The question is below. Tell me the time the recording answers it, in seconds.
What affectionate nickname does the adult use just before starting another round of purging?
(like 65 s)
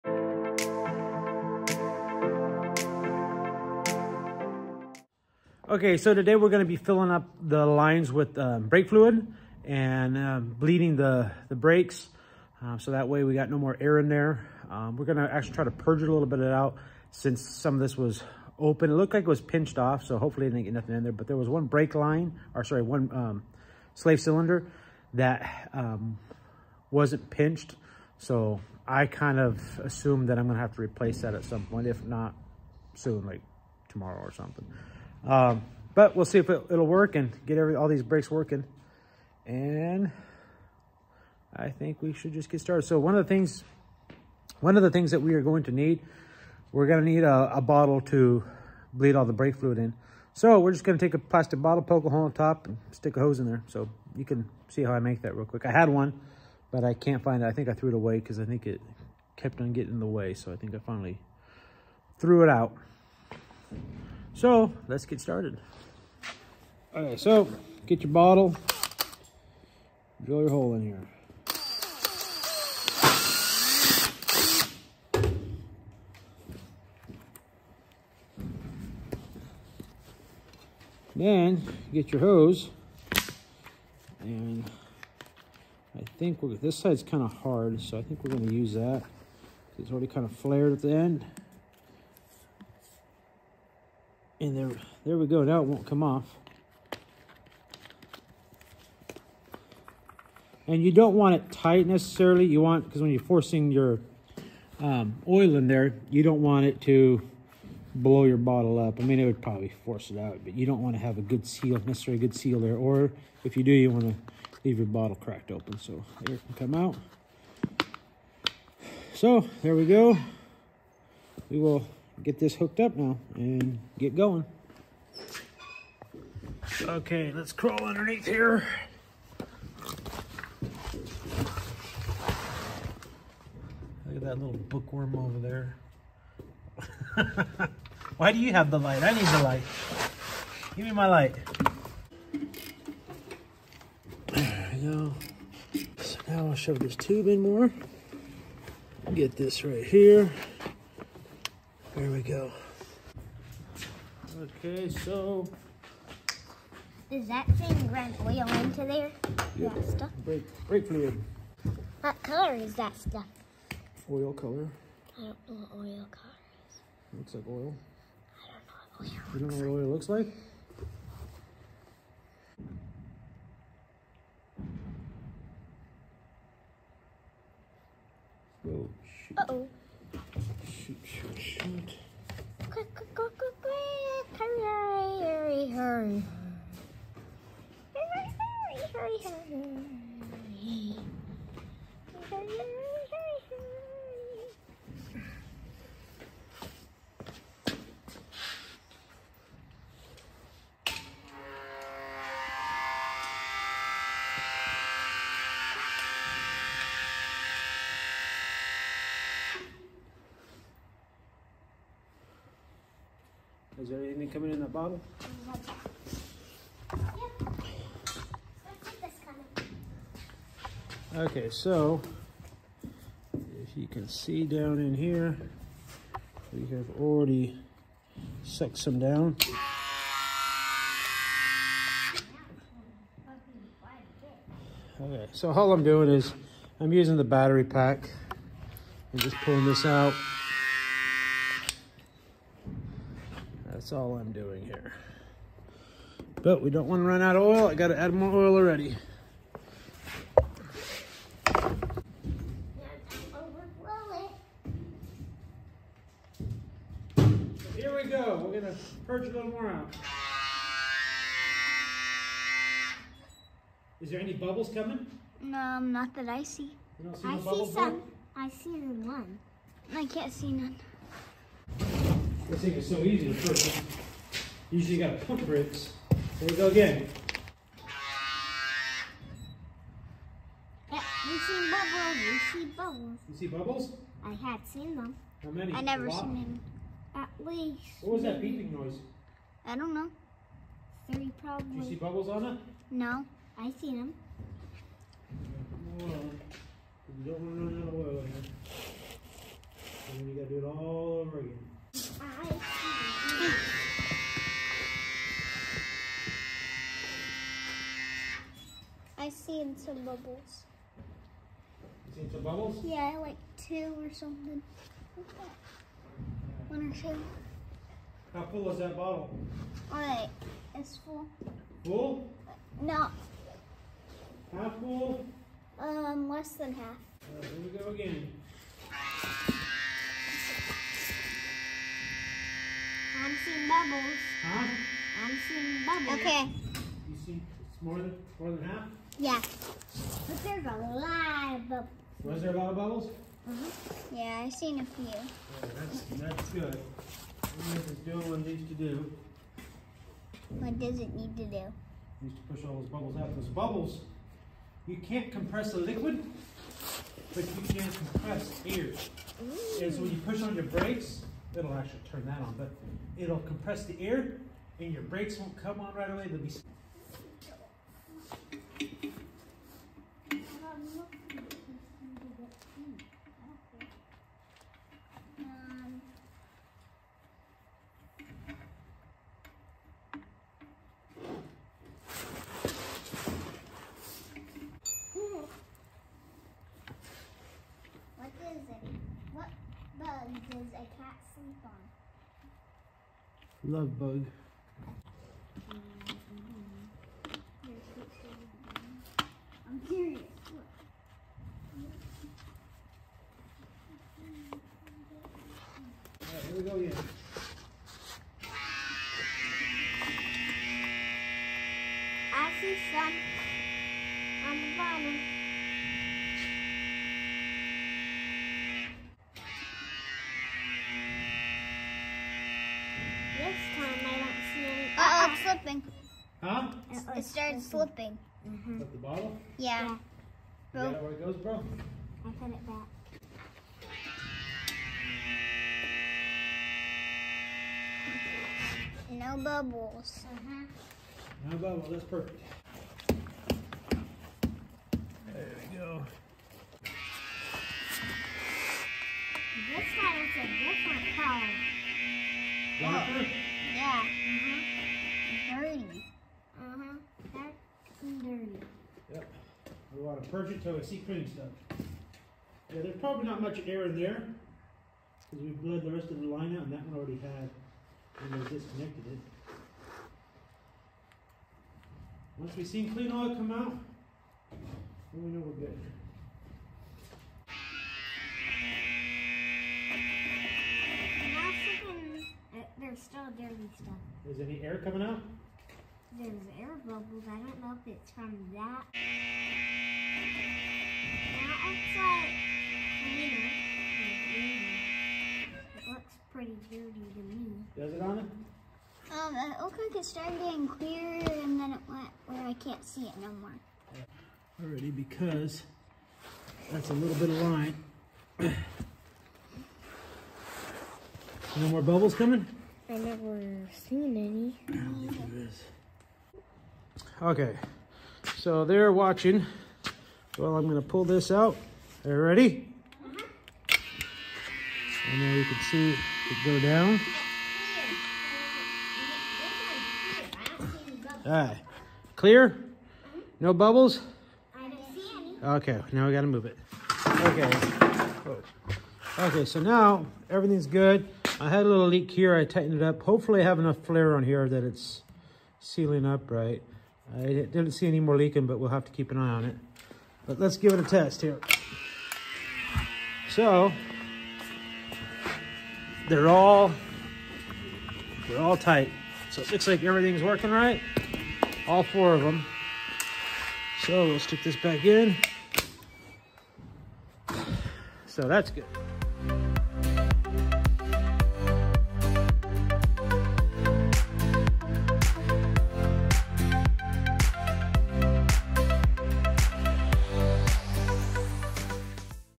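393 s.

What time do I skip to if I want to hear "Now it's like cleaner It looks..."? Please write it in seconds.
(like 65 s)
491 s.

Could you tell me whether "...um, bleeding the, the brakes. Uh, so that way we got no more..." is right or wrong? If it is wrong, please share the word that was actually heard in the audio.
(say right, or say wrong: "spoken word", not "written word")
right.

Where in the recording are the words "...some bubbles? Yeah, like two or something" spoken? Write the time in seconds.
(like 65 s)
312 s.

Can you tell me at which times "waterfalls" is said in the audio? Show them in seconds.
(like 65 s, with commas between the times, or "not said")
not said.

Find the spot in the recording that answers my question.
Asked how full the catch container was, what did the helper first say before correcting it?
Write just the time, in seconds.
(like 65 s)
326 s.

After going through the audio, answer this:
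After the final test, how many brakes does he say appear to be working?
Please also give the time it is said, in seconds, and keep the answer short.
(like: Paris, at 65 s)
4, at 561 s.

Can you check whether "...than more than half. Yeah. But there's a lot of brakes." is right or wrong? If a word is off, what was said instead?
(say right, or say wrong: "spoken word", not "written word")
wrong: "bubbles", not "brakes".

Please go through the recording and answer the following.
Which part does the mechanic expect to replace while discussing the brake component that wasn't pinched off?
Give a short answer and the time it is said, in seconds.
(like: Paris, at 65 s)
Slave cylinder, at 23 s.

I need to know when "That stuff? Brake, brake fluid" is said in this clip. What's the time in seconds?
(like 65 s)
159 s.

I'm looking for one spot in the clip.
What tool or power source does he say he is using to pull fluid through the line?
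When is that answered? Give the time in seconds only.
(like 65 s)
237 s.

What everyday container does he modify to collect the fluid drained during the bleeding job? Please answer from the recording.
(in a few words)
Plastic bottle.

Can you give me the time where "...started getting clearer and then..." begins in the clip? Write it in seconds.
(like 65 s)
500 s.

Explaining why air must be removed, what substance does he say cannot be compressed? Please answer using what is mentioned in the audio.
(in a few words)
A liquid.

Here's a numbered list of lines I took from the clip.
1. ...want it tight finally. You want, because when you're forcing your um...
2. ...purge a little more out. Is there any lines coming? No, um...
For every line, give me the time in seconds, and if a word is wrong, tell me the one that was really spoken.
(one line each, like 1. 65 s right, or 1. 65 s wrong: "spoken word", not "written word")
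1. 101 s wrong: "necessarily", not "finally"
2. 259 s wrong: "bubbles", not "lines".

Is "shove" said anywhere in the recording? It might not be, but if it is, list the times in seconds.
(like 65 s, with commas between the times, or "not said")
146 s.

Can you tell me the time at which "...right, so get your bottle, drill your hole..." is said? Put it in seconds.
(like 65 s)
67 s.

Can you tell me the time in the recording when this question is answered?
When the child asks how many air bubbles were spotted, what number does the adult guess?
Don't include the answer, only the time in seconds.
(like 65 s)
291 s.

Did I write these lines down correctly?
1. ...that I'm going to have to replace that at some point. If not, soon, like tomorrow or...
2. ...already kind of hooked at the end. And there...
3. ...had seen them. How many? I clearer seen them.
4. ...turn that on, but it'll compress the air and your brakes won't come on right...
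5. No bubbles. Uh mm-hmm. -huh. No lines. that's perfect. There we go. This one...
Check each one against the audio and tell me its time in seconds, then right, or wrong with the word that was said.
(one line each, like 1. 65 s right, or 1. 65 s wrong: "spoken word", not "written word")
1. 30 s right
2. 89 s wrong: "flared", not "hooked"
3. 284 s wrong: "never", not "clearer"
4. 362 s right
5. 439 s wrong: "bubbles", not "lines".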